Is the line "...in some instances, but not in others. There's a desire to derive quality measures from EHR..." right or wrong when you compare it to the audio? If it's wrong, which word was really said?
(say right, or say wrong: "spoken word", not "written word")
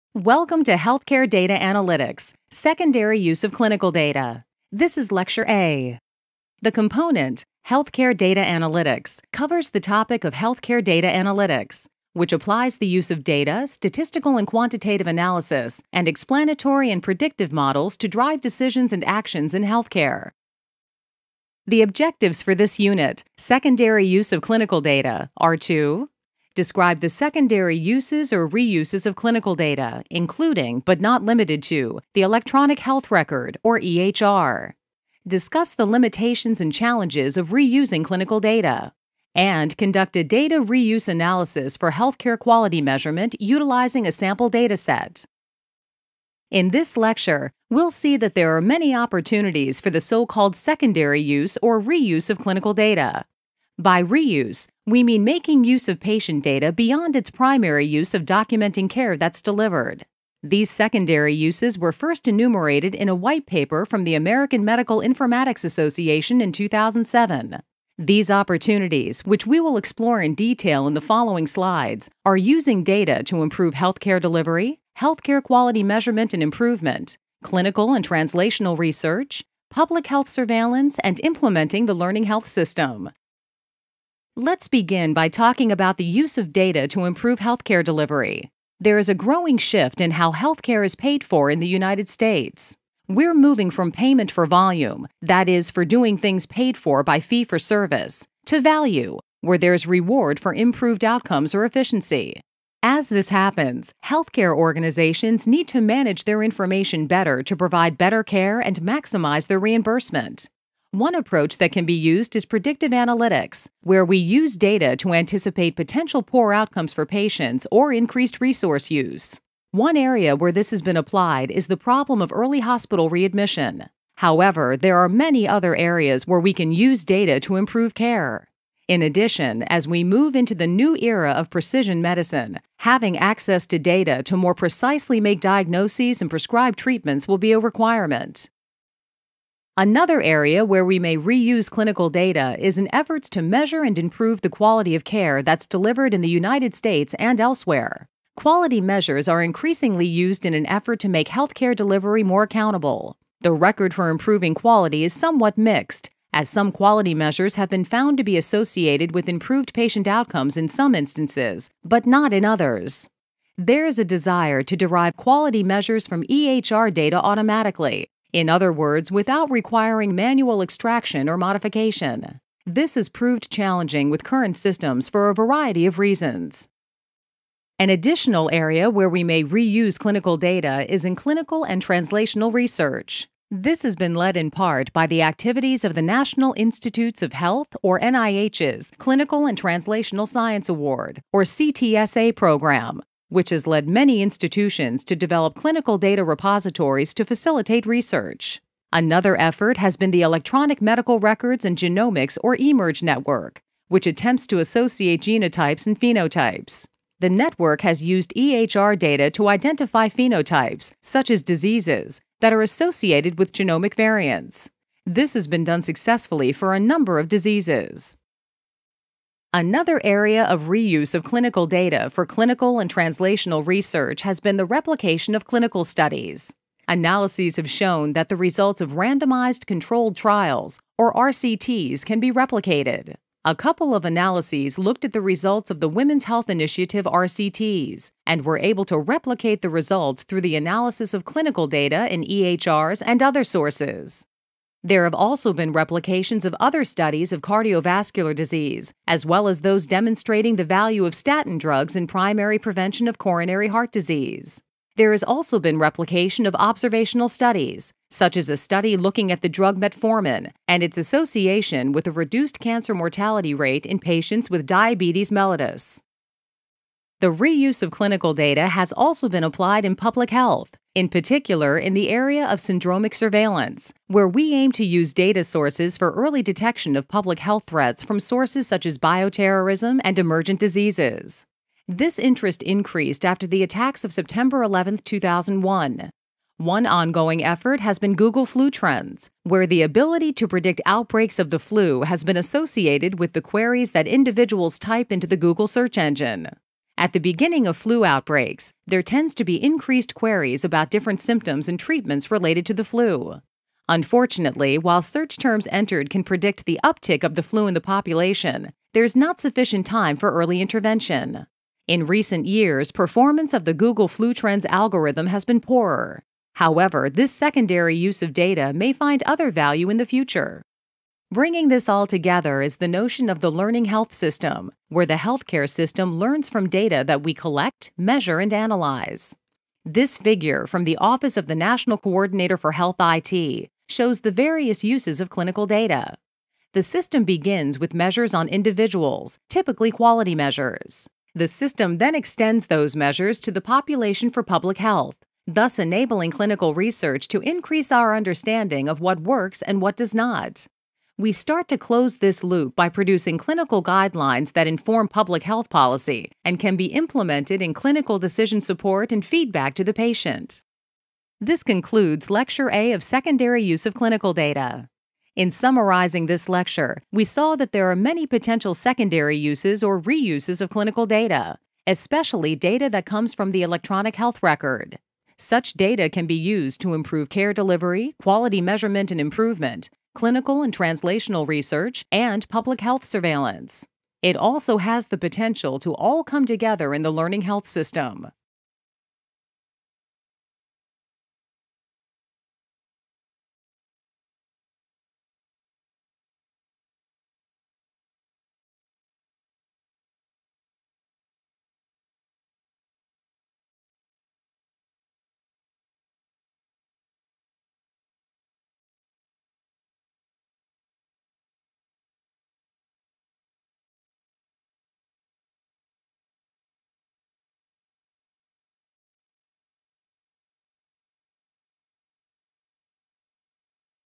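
right.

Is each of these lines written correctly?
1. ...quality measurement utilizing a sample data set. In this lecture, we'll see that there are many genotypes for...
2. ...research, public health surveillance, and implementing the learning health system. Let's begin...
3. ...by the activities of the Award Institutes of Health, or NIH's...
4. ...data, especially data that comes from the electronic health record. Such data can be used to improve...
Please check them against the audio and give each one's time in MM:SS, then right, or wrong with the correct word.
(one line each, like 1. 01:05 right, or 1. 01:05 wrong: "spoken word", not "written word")
1. 00:42 wrong: "opportunities", not "genotypes"
2. 01:18 right
3. 03:04 wrong: "National", not "Award"
4. 06:11 right.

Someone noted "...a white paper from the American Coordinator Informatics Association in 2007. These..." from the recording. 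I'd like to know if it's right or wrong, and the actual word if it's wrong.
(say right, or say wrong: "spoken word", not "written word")
wrong: "Medical", not "Coordinator".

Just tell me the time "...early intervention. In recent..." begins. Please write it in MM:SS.
05:10.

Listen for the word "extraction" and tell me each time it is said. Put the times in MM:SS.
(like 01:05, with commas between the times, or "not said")
02:50.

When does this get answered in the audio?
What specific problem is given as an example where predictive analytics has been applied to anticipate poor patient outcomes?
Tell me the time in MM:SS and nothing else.
02:02.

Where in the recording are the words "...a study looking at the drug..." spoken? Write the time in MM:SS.
04:18.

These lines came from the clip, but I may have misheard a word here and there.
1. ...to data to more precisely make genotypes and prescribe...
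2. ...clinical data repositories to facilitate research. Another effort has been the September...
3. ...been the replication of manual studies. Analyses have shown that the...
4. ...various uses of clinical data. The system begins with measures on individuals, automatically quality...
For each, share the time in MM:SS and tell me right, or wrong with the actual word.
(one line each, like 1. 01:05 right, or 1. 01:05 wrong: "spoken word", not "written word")
1. 02:13 wrong: "diagnoses", not "genotypes"
2. 03:15 wrong: "Electronic", not "September"
3. 03:44 wrong: "clinical", not "manual"
4. 05:34 wrong: "typically", not "automatically".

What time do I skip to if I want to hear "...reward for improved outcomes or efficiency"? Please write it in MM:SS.
01:39.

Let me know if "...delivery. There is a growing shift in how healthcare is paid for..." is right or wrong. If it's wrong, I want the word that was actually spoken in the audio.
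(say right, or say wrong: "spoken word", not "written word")
right.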